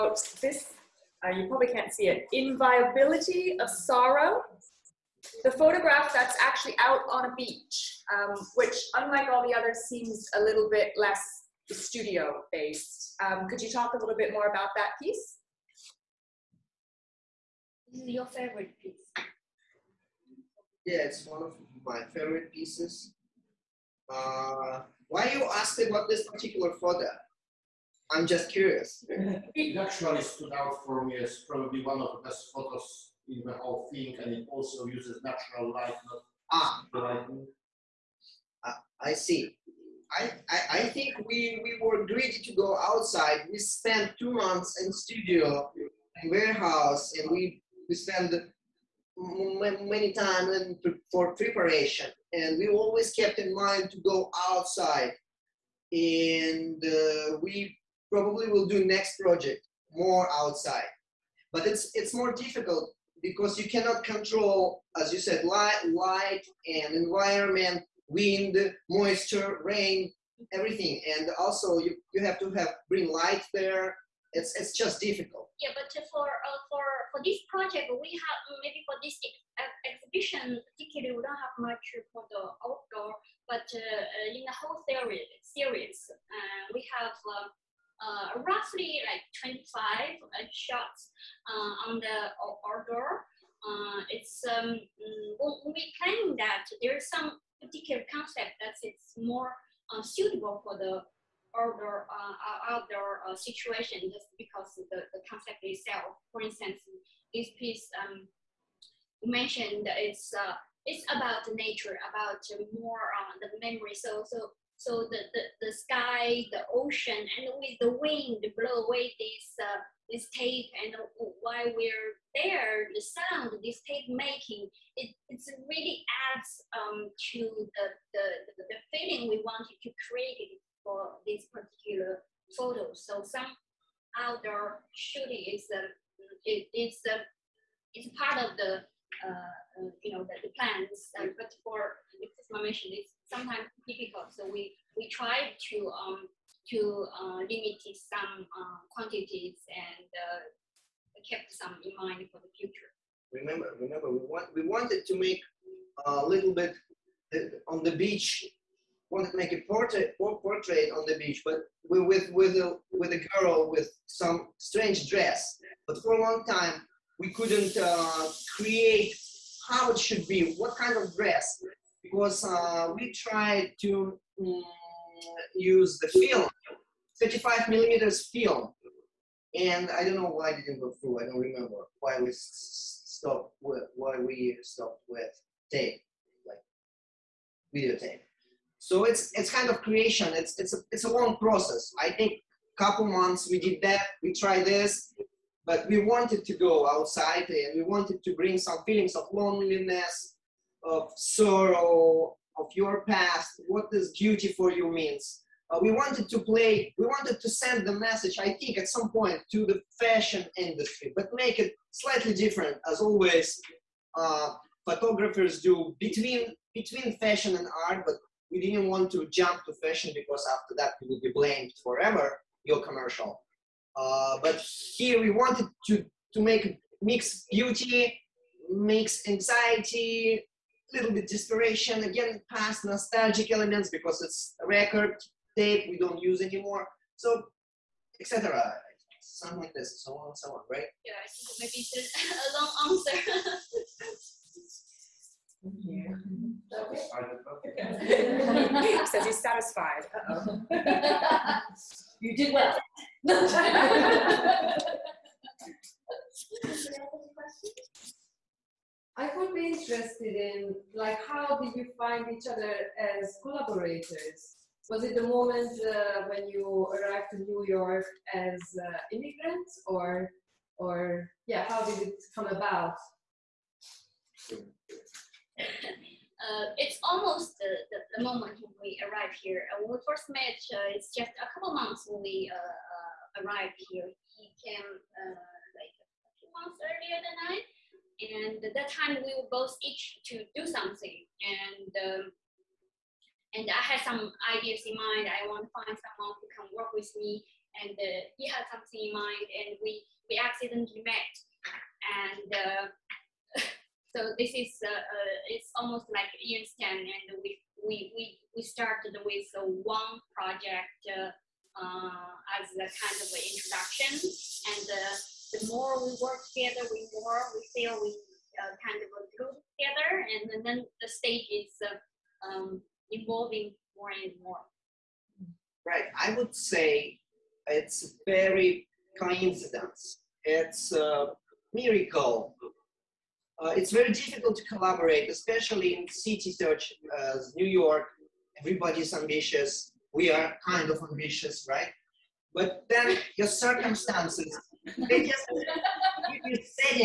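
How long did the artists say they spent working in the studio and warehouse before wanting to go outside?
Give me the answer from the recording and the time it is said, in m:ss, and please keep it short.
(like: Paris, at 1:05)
2 months, at 0:44.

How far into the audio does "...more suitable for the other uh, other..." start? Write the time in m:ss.
1:39.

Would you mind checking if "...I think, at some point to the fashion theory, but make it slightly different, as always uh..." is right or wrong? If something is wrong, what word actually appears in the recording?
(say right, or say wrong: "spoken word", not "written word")
wrong: "industry", not "theory".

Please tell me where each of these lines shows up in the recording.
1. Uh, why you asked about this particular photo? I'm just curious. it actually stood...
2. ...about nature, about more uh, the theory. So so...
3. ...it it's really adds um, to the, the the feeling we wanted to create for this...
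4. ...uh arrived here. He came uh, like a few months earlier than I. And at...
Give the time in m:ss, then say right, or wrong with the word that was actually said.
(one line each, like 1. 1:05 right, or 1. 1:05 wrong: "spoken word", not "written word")
1. 0:24 right
2. 1:51 wrong: "memory", not "theory"
3. 2:04 right
4. 4:42 right.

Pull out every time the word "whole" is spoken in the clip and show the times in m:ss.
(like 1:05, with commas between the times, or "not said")
0:33, 1:24.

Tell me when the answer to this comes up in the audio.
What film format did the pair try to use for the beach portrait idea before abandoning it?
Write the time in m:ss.
2:57.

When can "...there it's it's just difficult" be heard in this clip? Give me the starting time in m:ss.
1:13.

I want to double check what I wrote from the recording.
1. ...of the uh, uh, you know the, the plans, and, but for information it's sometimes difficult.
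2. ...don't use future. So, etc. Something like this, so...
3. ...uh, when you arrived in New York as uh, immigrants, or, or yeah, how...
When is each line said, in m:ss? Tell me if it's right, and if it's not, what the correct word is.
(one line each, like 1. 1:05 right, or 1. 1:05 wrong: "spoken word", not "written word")
1. 2:18 right
2. 3:55 wrong: "anymore", not "future"
3. 4:25 right.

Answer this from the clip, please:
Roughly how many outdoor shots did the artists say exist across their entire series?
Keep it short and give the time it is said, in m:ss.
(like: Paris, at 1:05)
25, at 1:29.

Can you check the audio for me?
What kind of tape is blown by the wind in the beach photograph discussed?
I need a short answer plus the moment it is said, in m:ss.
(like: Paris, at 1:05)
videotape, at 3:07.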